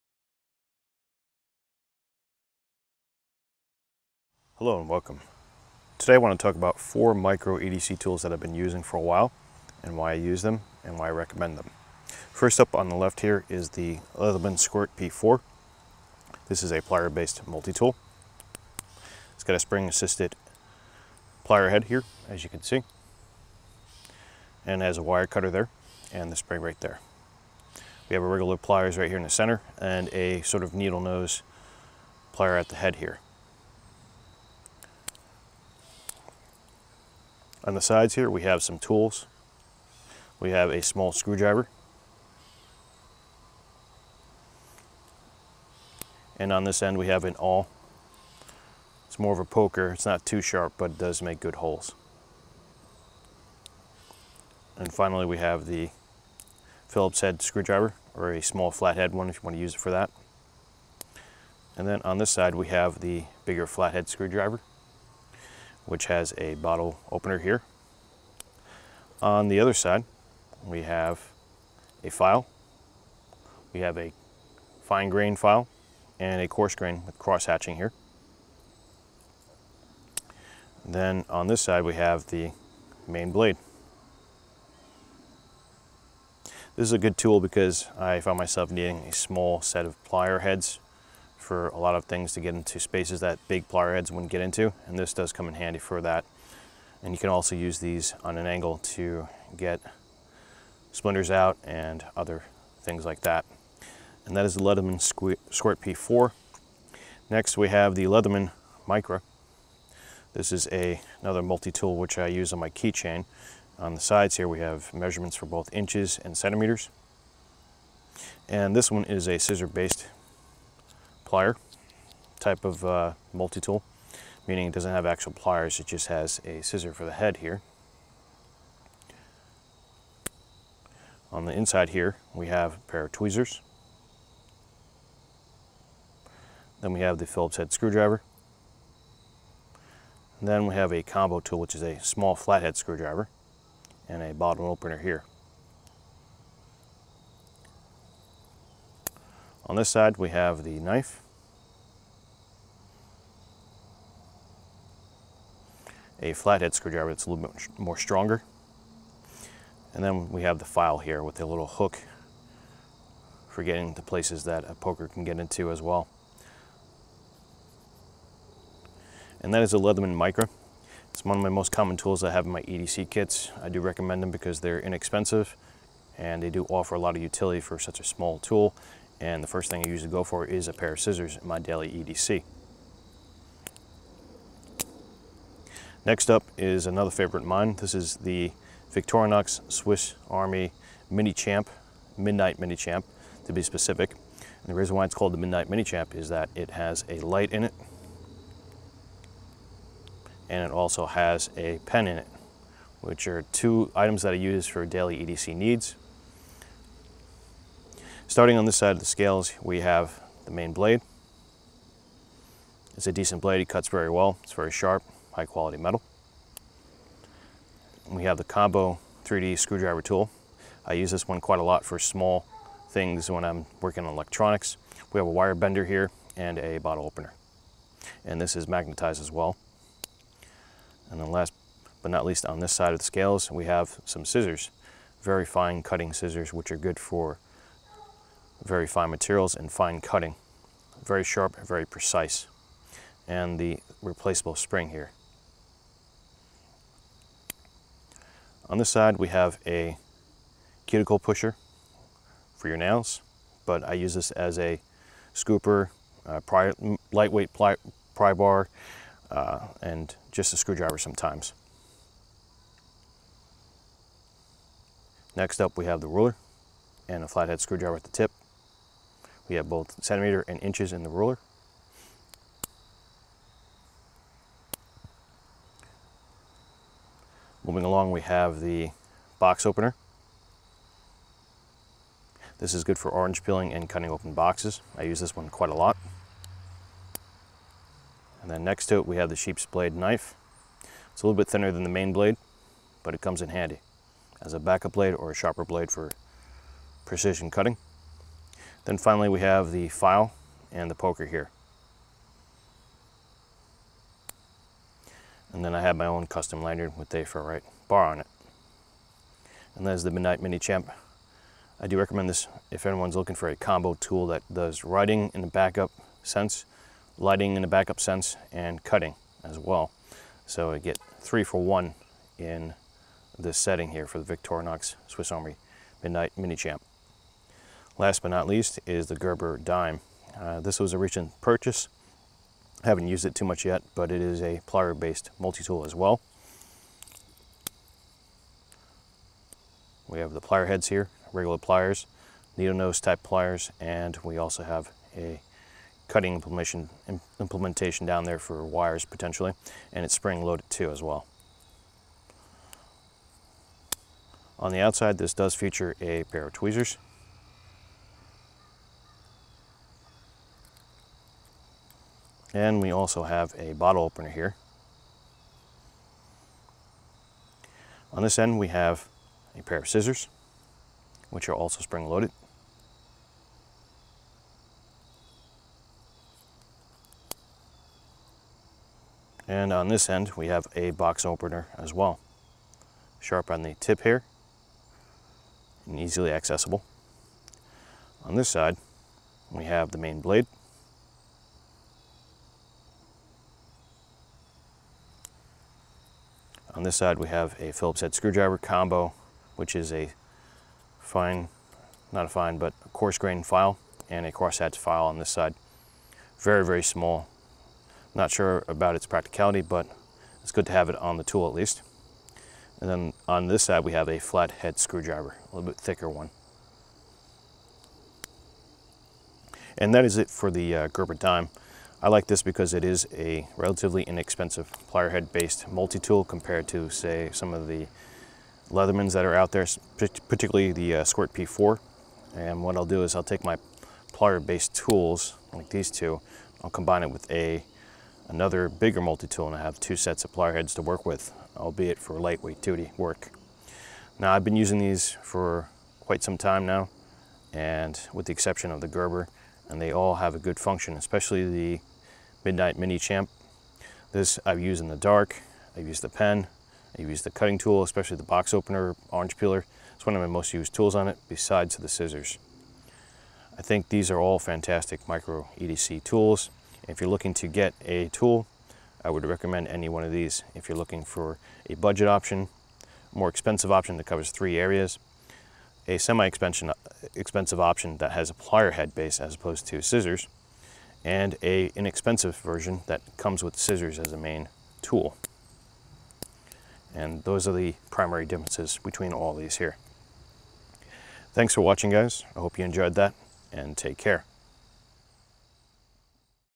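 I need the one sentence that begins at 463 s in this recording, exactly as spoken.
I think these are all fantastic micro EDC tools.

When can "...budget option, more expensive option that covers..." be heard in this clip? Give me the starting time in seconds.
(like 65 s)
471 s.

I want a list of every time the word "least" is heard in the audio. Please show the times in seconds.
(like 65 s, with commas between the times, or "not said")
232 s, 328 s, 411 s.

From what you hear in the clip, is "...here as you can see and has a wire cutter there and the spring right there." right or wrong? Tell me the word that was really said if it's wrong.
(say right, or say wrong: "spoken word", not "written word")
right.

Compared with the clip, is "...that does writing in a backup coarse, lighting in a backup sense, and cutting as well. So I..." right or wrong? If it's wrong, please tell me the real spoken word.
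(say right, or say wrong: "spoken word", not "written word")
wrong: "sense", not "coarse".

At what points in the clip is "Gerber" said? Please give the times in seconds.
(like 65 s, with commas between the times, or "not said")
329 s, 420 s, 448 s.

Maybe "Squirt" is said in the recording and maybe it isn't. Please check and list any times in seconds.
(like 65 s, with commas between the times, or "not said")
14 s, 105 s, 431 s.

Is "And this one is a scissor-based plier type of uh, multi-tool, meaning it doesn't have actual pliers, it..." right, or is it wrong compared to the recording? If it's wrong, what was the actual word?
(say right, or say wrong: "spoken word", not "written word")
right.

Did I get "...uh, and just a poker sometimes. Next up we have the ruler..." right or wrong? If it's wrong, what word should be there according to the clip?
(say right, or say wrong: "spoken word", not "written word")
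wrong: "screwdriver", not "poker".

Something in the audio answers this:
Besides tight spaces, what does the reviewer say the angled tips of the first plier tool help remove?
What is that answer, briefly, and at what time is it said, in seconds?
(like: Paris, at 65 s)
splinters, at 100 s.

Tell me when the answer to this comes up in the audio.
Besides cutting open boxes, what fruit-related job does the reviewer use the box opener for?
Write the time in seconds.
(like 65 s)
283 s.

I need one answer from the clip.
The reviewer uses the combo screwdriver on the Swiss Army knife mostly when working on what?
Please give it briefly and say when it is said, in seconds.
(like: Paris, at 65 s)
electronics, at 224 s.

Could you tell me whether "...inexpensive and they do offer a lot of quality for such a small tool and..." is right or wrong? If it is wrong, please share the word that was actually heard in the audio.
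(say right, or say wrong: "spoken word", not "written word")
wrong: "utility", not "quality".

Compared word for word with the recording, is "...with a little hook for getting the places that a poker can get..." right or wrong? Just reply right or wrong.
right.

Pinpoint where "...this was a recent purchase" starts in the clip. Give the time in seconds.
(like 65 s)
330 s.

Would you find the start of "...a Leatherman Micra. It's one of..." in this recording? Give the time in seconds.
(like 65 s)
169 s.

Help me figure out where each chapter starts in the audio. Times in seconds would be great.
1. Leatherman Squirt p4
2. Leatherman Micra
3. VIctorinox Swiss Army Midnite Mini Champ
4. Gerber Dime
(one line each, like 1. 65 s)
1. 12 s
2. 106 s
3. 185 s
4. 327 s.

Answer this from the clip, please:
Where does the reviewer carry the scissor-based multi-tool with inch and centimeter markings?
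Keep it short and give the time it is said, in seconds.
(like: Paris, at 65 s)
on my keychain, at 112 s.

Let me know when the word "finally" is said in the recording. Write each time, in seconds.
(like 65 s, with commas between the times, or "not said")
54 s, 298 s.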